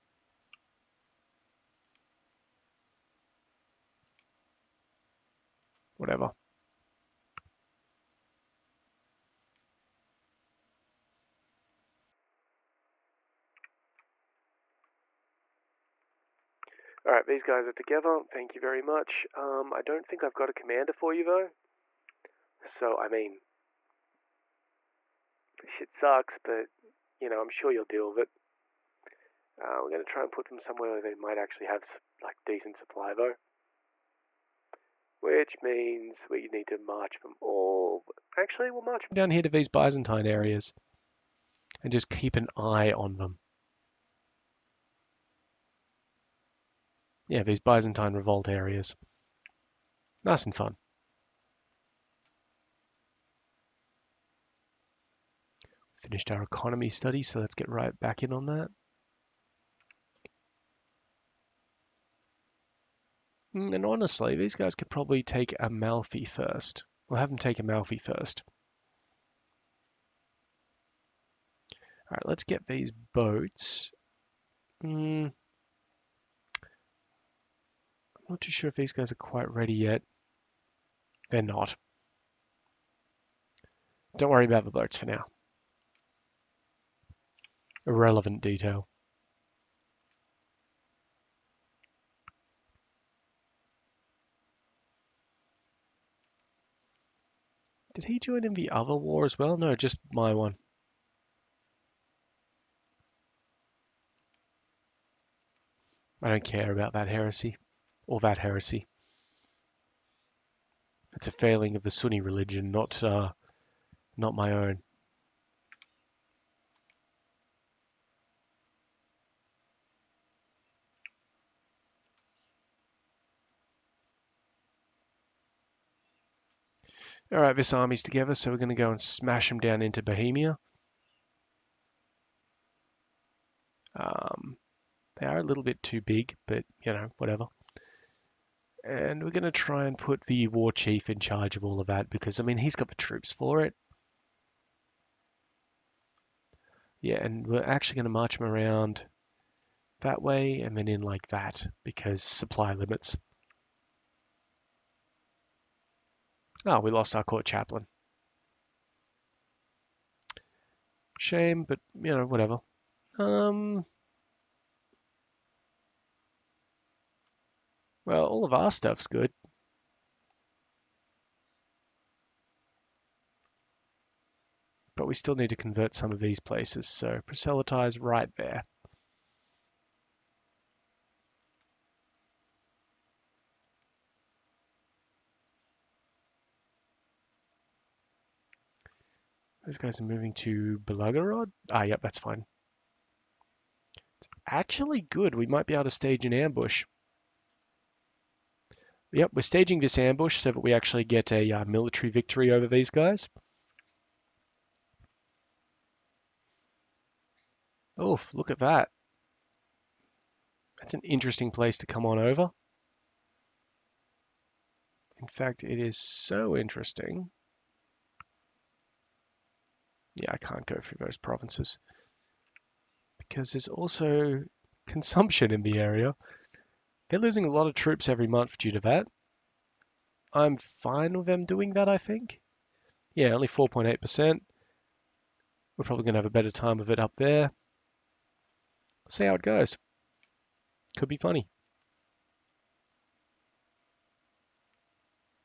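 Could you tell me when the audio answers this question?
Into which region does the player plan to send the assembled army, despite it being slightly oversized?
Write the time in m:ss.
2:10.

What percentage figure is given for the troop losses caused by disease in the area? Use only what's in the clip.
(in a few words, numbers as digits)
4.8%.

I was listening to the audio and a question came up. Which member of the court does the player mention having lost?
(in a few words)
Court chaplain.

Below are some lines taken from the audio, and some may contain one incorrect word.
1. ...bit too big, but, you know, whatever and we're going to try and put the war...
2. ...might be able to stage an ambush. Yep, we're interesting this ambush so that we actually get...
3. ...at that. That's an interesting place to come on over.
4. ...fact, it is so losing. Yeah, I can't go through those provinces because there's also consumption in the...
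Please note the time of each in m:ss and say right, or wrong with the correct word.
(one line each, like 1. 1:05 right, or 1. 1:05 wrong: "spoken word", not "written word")
1. 2:15 right
2. 3:15 wrong: "staging", not "interesting"
3. 3:28 right
4. 3:35 wrong: "interesting", not "losing".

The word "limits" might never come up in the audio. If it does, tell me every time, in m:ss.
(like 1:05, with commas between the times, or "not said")
2:32.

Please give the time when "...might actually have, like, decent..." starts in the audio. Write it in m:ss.
0:31.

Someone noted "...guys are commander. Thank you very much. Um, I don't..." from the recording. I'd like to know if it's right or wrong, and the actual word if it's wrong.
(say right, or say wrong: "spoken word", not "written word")
wrong: "together", not "commander".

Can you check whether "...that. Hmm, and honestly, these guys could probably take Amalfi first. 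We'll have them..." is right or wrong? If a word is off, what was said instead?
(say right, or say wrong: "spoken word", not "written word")
right.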